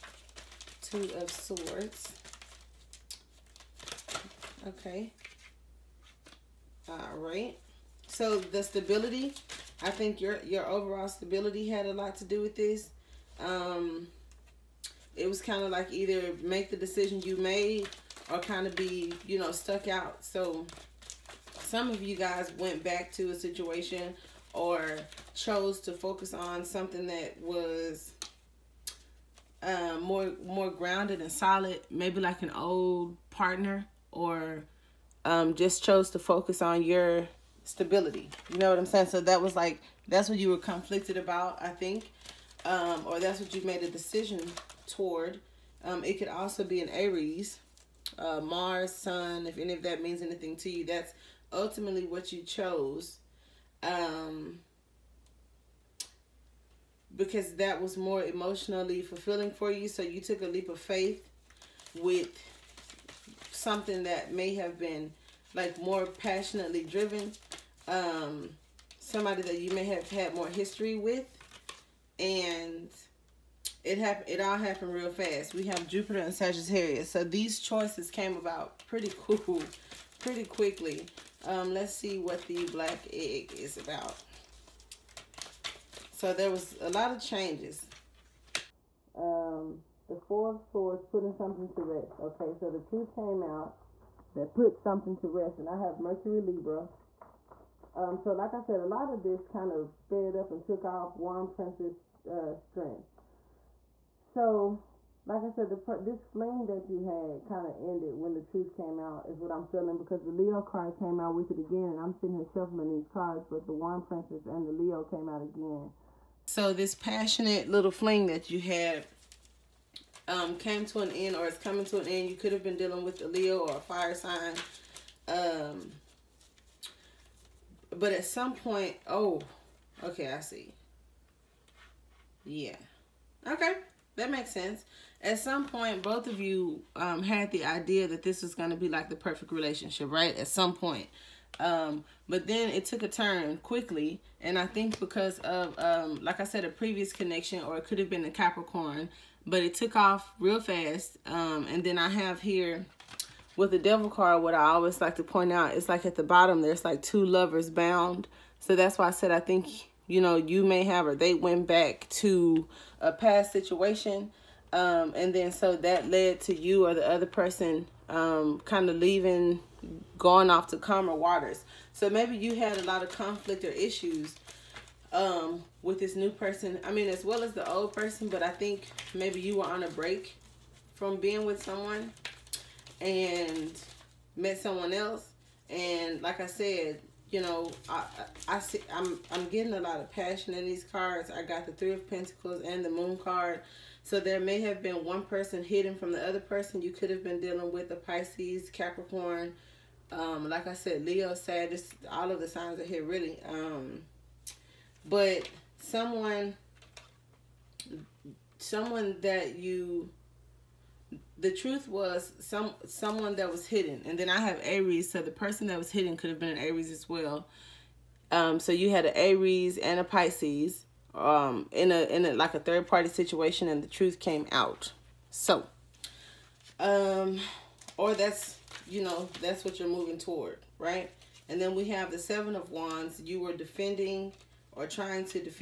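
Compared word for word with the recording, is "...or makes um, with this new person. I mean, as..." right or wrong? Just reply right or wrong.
wrong.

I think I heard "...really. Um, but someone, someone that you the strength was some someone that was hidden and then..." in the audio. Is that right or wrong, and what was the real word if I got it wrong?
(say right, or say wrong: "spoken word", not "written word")
wrong: "truth", not "strength".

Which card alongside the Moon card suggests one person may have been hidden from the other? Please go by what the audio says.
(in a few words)
Three of Pentacles.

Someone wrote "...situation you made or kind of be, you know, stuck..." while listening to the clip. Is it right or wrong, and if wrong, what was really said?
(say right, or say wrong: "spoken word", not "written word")
wrong: "decision", not "situation".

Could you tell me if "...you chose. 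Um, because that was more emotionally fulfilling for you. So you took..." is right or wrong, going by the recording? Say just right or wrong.
right.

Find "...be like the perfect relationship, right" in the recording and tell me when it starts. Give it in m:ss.
2:18.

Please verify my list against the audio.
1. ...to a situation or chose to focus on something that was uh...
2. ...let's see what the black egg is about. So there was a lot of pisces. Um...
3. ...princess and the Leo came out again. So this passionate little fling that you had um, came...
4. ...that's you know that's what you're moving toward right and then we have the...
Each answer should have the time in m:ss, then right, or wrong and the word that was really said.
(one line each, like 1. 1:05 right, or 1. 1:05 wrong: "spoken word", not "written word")
1. 0:23 right
2. 1:21 wrong: "changes", not "pisces"
3. 1:54 right
4. 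3:48 right.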